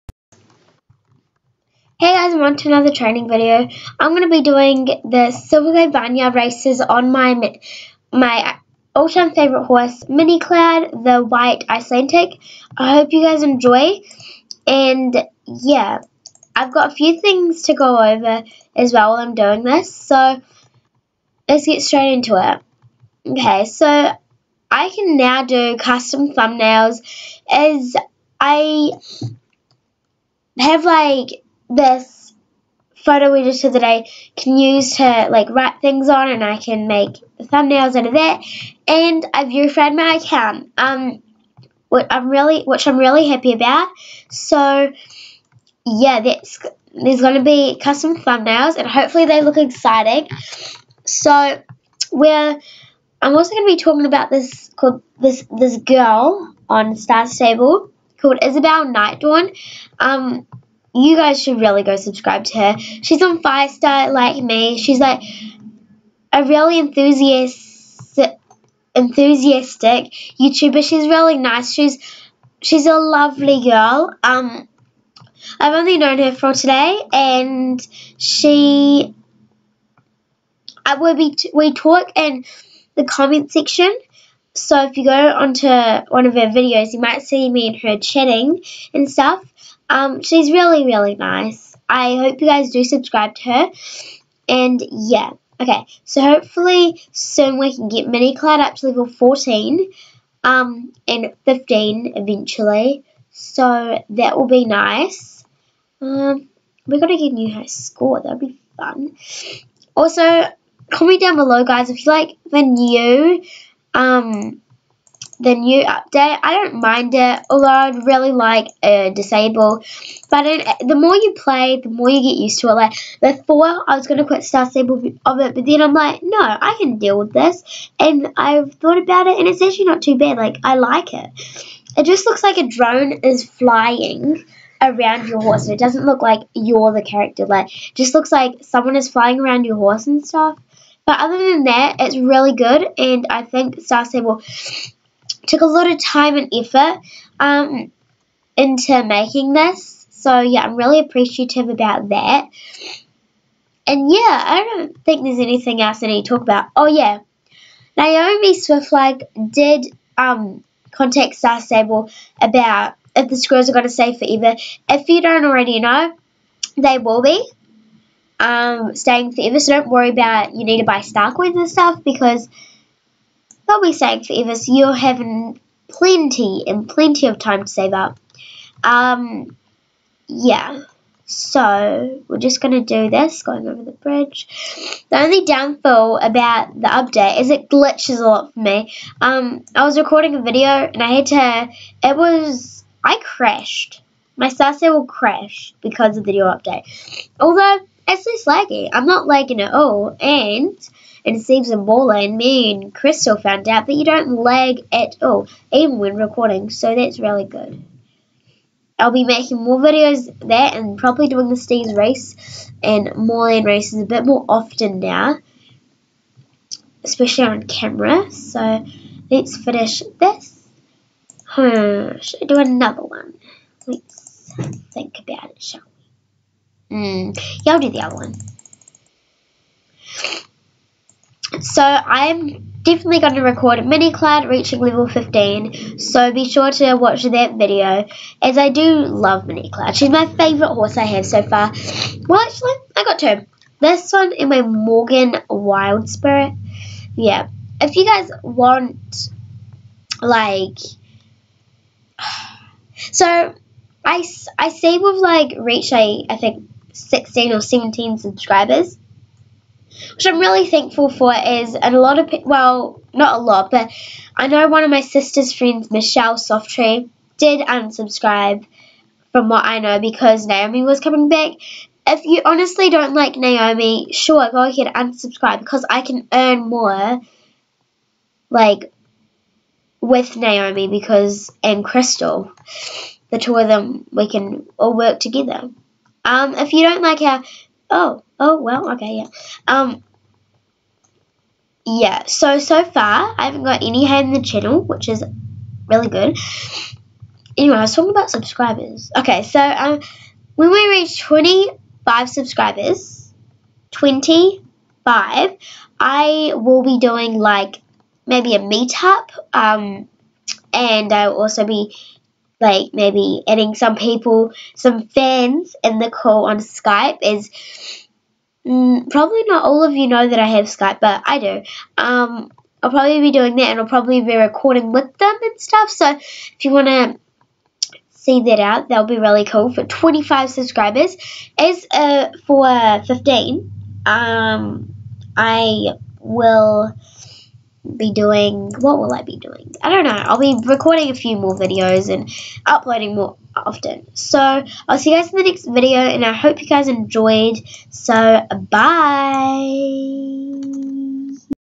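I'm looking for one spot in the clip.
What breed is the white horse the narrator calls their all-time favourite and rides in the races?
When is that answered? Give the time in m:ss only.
0:11.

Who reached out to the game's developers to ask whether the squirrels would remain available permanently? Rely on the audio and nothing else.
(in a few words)
Naomi Swiftluck.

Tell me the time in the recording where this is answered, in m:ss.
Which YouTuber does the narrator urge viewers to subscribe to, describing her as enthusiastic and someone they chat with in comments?
0:58.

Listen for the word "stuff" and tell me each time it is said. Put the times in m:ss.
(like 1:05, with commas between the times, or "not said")
1:29, 2:20, 2:51, 5:25.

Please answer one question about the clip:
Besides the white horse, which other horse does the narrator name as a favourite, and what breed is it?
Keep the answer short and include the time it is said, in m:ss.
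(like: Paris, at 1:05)
Morgan, Wild Spirit, at 4:04.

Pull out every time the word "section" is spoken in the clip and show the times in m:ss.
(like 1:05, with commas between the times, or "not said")
1:23.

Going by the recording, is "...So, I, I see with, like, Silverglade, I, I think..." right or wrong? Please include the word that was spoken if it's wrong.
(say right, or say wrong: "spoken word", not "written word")
wrong: "Reach", not "Silverglade".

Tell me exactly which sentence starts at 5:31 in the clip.
As uh, for 15, um, I will be doing what will I be doing?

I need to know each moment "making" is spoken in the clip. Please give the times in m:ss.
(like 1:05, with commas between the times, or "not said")
2:29, 3:29.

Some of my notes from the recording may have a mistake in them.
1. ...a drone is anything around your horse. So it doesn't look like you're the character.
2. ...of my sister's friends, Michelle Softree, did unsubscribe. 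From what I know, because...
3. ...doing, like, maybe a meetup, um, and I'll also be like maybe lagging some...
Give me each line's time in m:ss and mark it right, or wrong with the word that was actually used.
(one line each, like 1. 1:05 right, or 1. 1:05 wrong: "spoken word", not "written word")
1. 2:12 wrong: "flying", not "anything"
2. 4:24 right
3. 5:06 wrong: "adding", not "lagging".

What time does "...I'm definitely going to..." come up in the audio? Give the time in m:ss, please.
3:51.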